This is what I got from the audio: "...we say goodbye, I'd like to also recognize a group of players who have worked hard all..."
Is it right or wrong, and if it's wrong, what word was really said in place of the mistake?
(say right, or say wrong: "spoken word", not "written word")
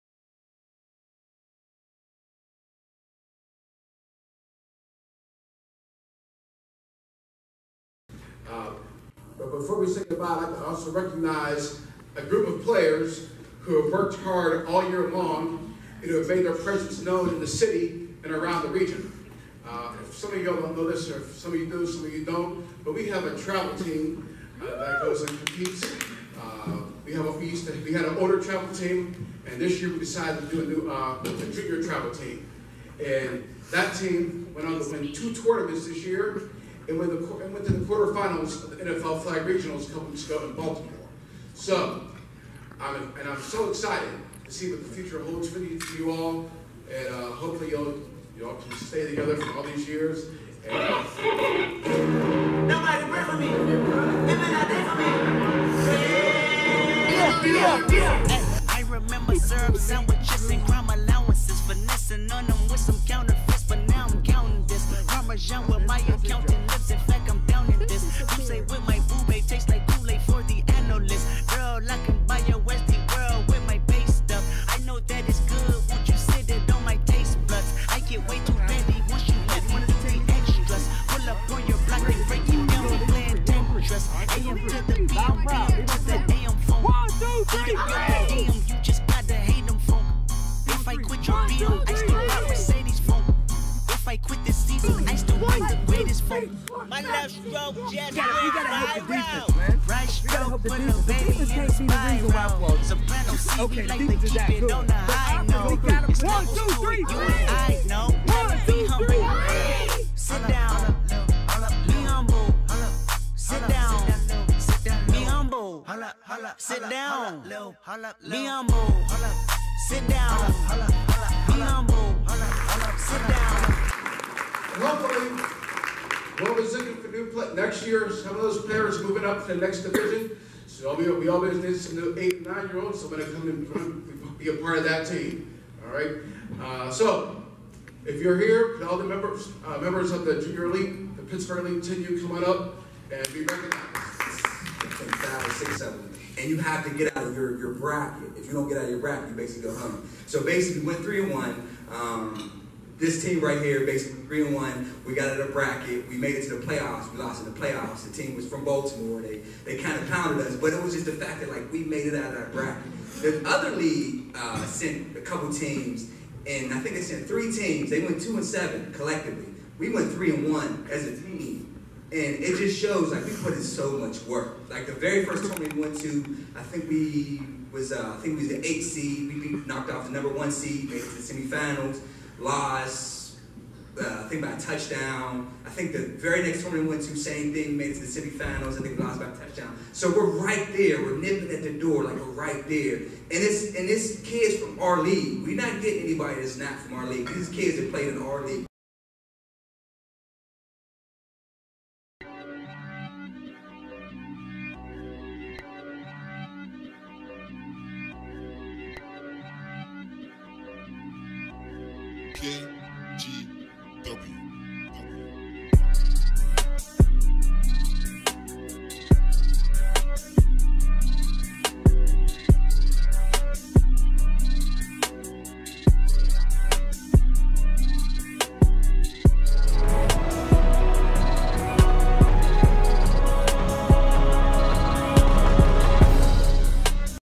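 right.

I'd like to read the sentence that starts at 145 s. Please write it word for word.
Five, six, seven and you have to get out of your, your bracket.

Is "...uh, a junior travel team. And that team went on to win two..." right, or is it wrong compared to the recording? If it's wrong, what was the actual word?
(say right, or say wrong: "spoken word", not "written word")
right.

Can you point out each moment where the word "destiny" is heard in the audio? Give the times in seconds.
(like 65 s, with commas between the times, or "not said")
not said.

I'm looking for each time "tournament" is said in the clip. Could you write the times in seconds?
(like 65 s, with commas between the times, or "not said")
35 s, 175 s, 186 s.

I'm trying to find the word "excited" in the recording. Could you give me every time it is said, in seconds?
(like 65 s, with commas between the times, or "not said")
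43 s.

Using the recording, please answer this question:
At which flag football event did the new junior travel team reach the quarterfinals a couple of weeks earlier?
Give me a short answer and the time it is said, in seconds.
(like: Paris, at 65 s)
NFL Flag Regionals, at 38 s.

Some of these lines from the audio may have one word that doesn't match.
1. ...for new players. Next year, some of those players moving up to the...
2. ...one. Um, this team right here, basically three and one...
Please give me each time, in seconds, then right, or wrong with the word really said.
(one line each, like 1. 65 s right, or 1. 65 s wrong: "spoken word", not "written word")
1. 127 s right
2. 151 s right.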